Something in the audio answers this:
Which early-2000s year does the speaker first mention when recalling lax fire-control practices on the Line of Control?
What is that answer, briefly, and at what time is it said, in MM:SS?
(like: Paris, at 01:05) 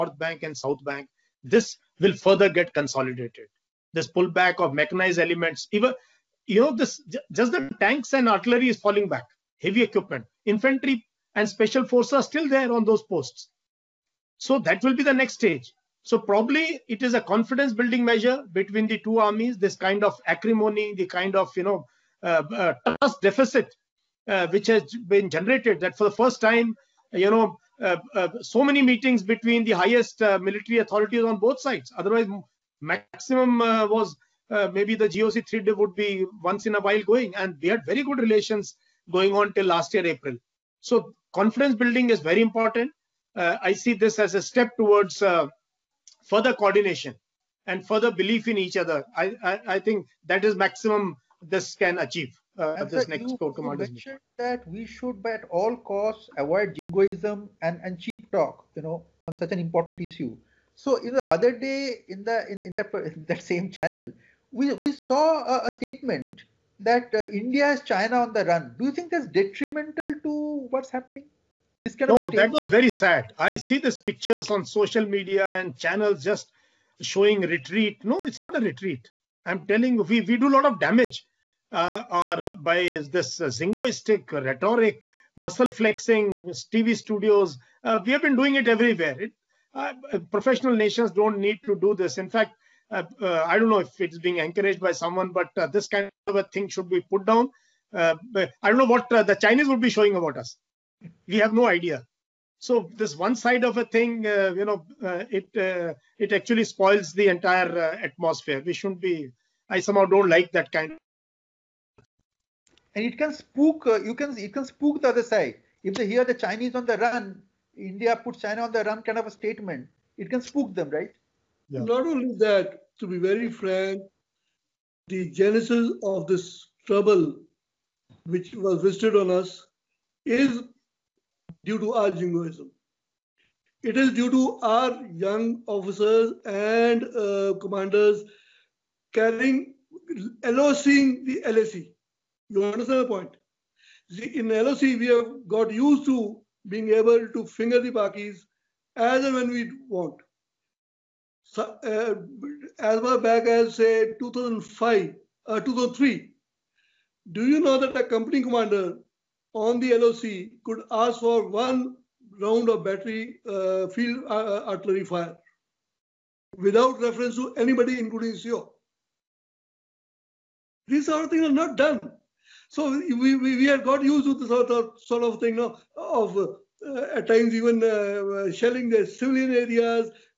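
2005, at 02:34.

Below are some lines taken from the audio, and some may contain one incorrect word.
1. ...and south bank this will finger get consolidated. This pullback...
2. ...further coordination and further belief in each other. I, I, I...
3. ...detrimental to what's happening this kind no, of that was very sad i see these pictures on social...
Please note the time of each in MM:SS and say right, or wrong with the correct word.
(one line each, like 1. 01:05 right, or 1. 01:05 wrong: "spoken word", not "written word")
1. 00:00 wrong: "further", not "finger"
2. 00:46 right
3. 01:09 right.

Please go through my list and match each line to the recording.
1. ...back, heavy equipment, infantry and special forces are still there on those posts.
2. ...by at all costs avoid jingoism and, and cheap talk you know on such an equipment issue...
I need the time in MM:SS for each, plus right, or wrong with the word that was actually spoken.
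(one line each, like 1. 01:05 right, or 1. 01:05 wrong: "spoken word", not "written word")
1. 00:09 right
2. 00:55 wrong: "important", not "equipment".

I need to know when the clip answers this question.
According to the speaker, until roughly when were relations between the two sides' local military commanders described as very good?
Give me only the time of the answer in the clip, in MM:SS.
00:39.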